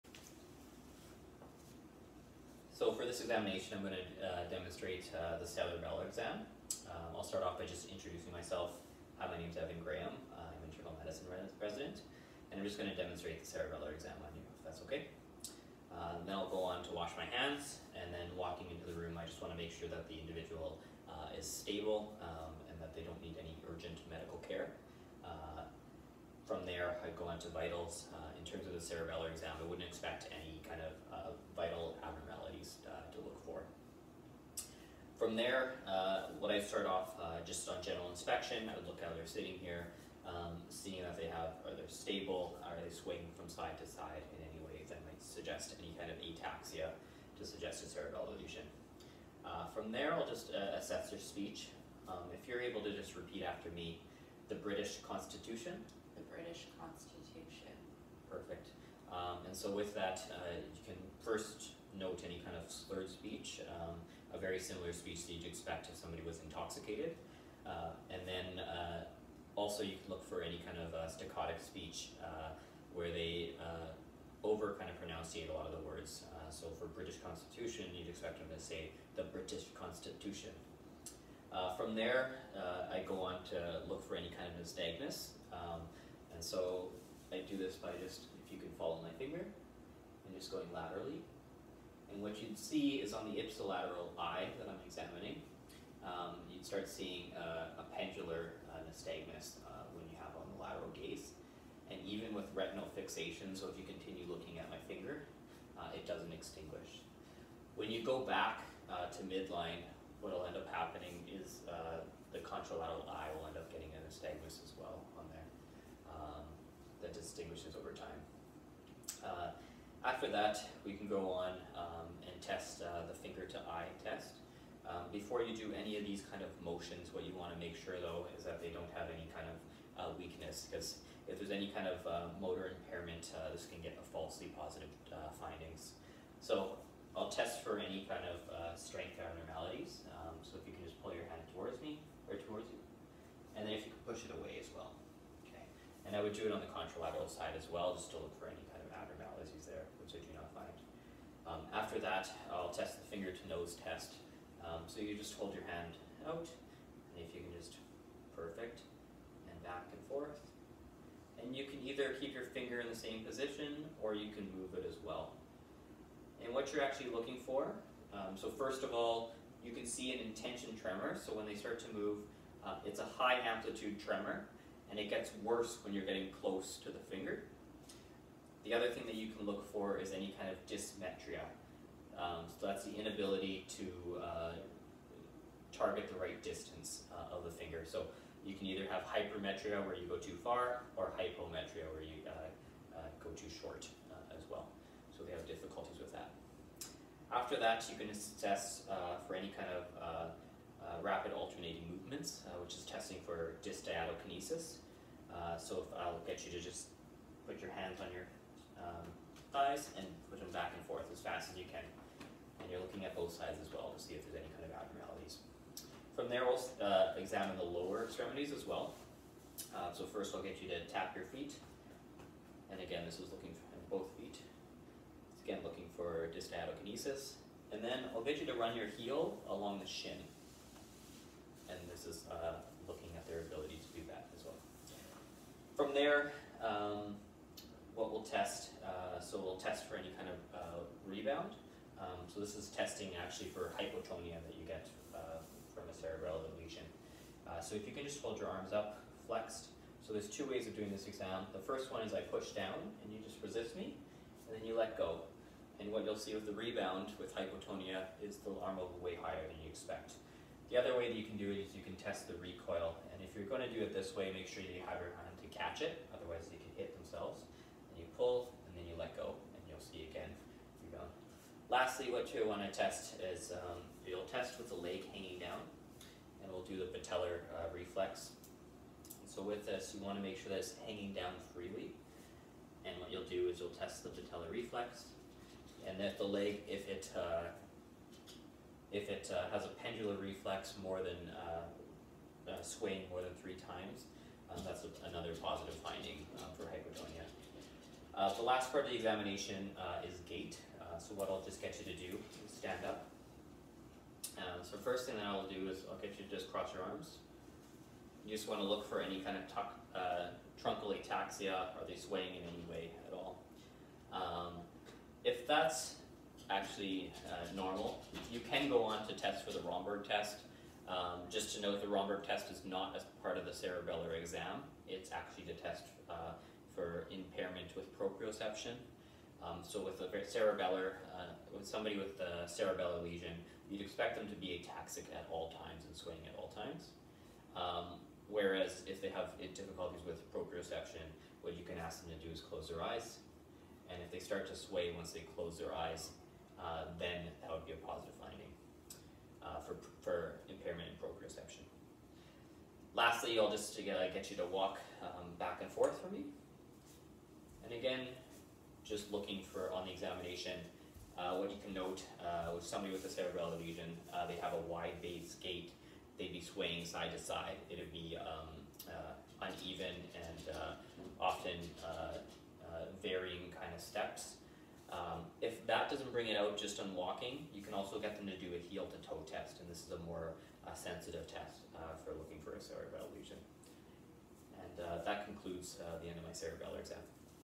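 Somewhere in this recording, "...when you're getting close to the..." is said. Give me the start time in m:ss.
2:55.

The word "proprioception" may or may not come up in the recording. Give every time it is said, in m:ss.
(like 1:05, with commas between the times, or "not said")
5:27, 5:40, 5:51.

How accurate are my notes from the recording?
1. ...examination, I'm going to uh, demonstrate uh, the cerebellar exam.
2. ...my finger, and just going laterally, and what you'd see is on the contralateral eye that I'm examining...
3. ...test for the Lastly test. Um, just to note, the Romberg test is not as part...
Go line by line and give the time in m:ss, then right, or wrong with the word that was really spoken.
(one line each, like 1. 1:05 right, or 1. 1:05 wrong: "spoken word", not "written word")
1. 0:03 right
2. 1:29 wrong: "ipsilateral", not "contralateral"
3. 5:19 wrong: "Romberg", not "Lastly".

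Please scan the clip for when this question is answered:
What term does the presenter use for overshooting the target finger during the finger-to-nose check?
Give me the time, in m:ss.
3:09.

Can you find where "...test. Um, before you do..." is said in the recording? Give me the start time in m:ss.
2:04.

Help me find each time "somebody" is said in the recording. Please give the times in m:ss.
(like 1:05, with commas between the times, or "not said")
1:05, 5:31, 6:02.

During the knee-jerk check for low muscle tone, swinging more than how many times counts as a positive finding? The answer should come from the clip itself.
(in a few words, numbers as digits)
3.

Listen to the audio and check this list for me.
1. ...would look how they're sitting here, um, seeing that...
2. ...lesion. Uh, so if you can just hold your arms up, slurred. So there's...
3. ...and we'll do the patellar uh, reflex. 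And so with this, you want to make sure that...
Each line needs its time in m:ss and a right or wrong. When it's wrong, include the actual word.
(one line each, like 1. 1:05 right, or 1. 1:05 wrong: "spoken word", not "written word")
1. 0:38 right
2. 4:06 wrong: "flexed", not "slurred"
3. 4:36 right.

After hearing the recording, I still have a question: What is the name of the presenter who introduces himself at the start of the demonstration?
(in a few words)
Evan Graham.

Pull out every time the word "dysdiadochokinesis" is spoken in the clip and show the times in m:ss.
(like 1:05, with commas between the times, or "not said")
3:23, 3:46.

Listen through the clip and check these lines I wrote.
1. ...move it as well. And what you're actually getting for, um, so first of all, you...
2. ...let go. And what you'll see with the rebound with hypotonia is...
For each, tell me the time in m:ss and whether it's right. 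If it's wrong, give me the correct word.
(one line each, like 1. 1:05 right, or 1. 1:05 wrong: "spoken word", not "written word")
1. 2:44 wrong: "looking", not "getting"
2. 4:14 right.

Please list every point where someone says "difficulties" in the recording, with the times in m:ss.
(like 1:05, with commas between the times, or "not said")
3:15, 5:39.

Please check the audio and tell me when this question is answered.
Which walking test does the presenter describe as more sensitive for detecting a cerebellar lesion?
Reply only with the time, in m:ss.
6:18.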